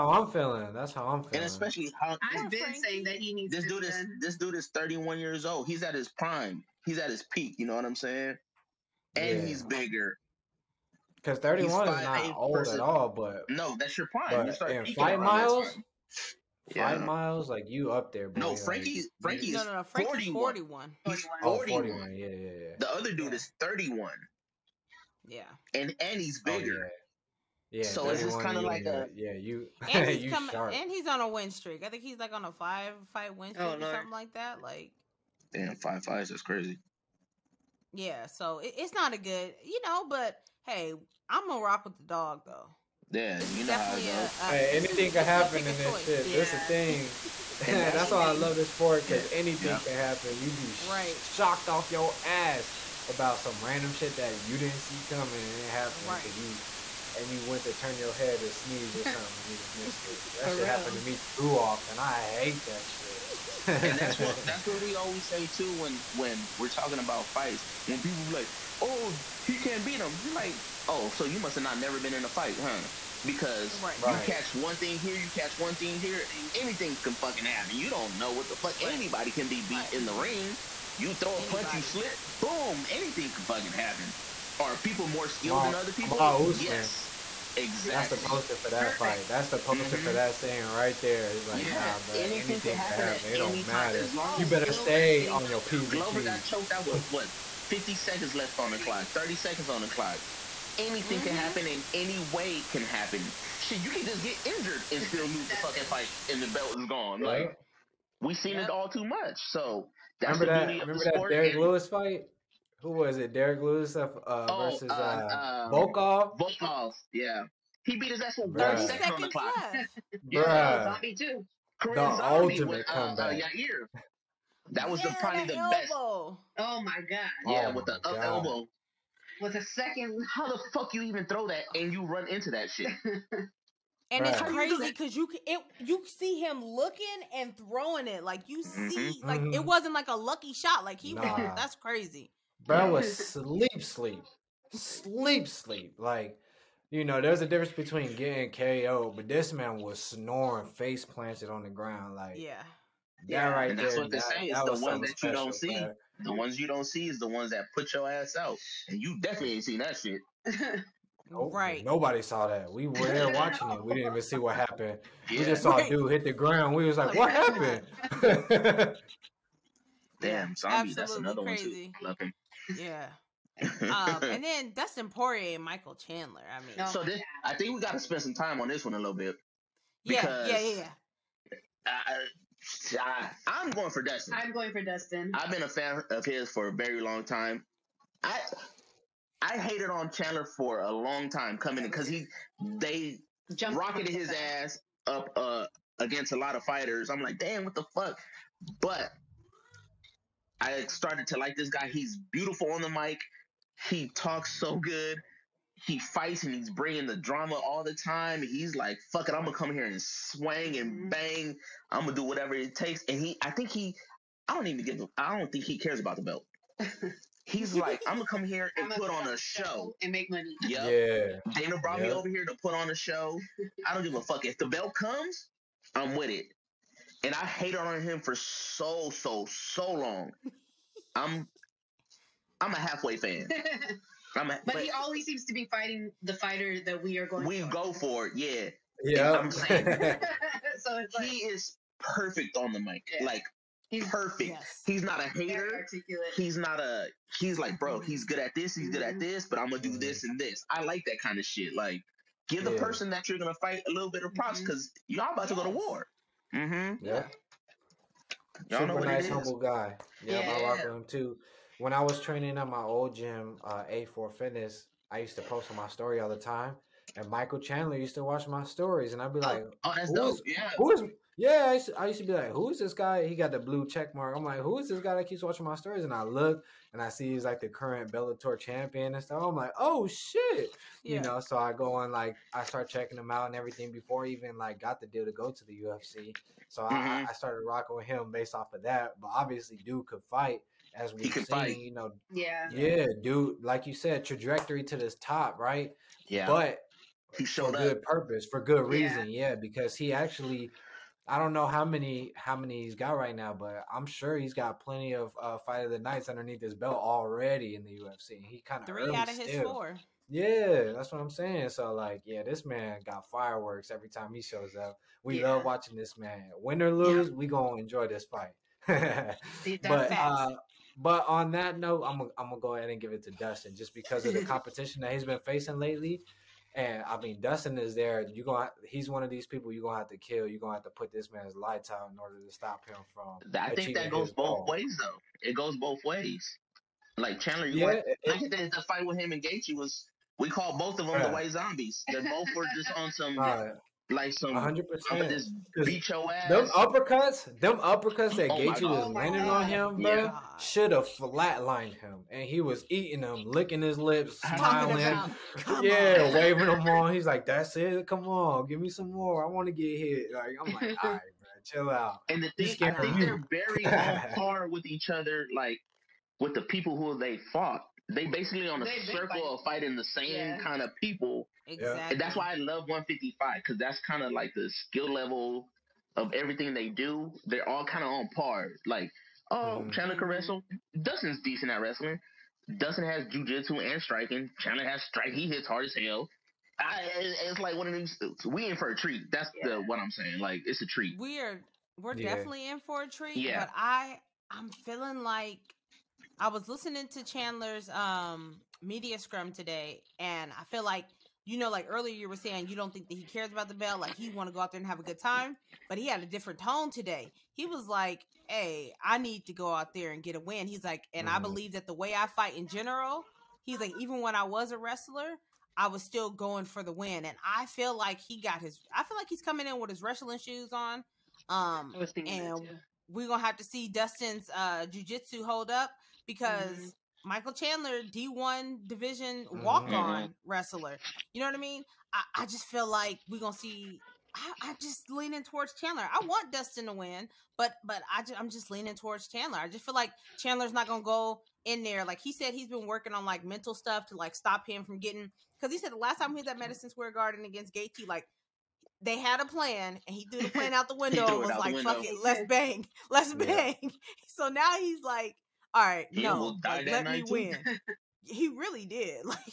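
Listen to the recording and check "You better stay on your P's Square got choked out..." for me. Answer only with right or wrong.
wrong.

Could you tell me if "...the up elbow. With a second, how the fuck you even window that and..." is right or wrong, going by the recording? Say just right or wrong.
wrong.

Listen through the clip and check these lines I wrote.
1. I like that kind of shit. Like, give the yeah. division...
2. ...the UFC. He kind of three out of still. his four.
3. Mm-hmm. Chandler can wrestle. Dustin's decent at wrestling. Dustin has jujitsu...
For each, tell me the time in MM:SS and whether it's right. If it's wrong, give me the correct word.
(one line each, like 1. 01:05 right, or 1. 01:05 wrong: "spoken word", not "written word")
1. 04:10 wrong: "person", not "division"
2. 05:07 right
3. 06:19 right.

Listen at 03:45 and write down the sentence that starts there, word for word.
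I'm with it and I hated on him for so so so long.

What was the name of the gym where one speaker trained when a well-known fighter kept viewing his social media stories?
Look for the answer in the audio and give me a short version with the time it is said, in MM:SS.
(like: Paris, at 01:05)
A4 Fitness, at 04:23.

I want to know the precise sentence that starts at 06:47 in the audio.
He was like, "Hey, I need to go out there and get a win." He's like, and mm-hmm.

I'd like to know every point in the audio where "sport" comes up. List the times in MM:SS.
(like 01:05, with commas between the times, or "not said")
00:48, 01:51.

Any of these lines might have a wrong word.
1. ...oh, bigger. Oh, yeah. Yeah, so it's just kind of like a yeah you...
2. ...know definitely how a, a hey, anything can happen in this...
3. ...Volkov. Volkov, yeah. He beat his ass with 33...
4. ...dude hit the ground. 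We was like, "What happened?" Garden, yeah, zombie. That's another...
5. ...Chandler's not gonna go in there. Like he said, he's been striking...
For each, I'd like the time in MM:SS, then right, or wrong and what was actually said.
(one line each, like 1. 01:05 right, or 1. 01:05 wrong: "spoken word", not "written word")
1. 00:26 right
2. 00:43 right
3. 01:55 wrong: "30", not "33"
4. 02:45 wrong: "Damn", not "Garden"
5. 07:20 wrong: "working", not "striking".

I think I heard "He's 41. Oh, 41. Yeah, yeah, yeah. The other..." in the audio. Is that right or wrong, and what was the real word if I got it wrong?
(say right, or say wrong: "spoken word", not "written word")
right.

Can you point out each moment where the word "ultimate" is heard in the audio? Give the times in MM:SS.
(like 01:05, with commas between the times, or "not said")
02:02.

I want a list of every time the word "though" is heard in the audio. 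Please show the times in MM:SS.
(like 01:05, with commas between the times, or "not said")
00:42, 05:34.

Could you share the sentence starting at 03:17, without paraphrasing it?
I'm like, damn, what the fuck?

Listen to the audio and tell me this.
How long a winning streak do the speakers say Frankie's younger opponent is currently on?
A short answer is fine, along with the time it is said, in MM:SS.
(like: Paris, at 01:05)
5, at 00:32.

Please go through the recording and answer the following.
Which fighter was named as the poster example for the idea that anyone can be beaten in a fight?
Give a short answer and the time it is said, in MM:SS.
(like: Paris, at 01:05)
Usman, at 01:26.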